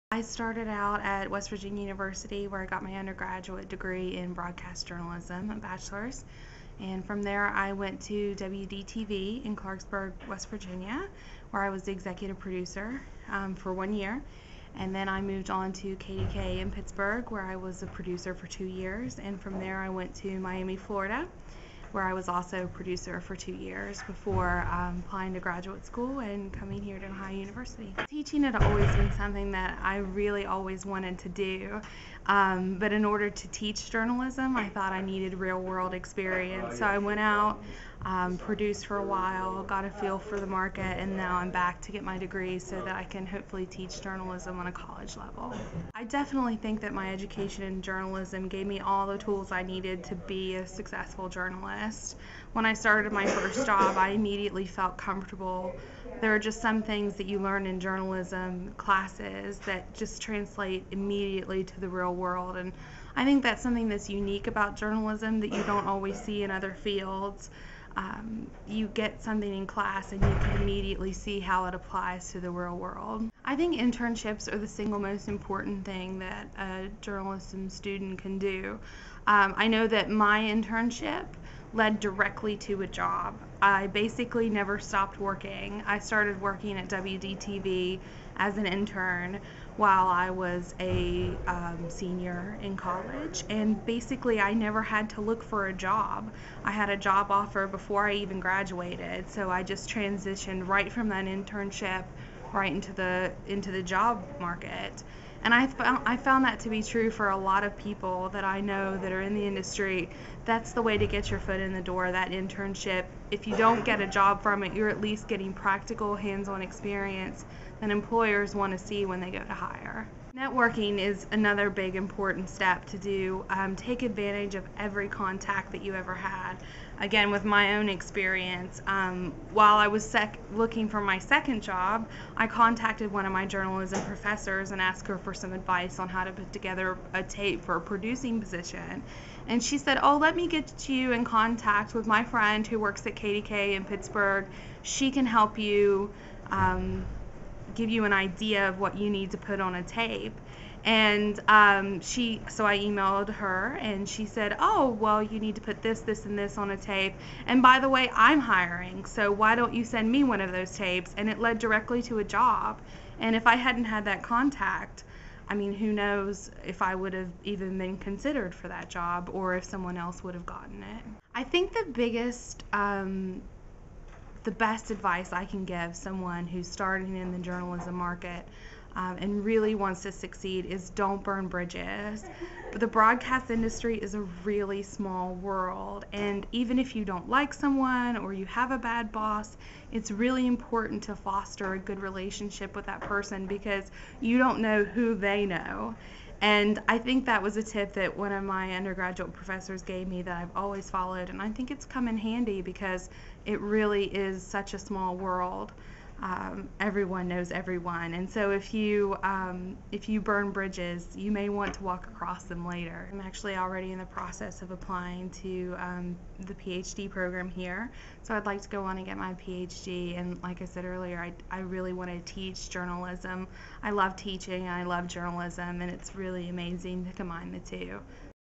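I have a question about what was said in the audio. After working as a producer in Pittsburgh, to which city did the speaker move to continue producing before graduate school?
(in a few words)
Miami.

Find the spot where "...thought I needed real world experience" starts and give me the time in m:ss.
0:34.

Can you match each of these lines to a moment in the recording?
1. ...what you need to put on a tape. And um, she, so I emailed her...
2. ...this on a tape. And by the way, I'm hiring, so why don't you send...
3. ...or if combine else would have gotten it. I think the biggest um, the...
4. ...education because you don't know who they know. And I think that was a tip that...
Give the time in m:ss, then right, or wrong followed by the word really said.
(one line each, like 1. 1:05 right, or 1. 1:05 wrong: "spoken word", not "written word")
1. 2:28 right
2. 2:36 right
3. 2:49 wrong: "someone", not "combine"
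4. 3:12 wrong: "person", not "education".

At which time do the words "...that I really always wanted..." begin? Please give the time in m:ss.
0:29.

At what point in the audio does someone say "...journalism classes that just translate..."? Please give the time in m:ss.
0:57.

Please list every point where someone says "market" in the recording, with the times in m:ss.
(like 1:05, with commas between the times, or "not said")
0:40, 1:44, 2:57.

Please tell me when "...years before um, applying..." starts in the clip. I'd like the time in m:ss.
0:23.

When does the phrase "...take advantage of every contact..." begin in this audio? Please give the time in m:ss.
2:03.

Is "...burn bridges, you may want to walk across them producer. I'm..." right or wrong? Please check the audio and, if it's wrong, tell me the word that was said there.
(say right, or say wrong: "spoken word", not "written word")
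wrong: "later", not "producer".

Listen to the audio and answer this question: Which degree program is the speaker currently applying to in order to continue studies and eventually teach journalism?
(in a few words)
PhD program.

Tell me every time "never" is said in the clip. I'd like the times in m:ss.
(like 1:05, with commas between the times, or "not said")
1:24, 1:34.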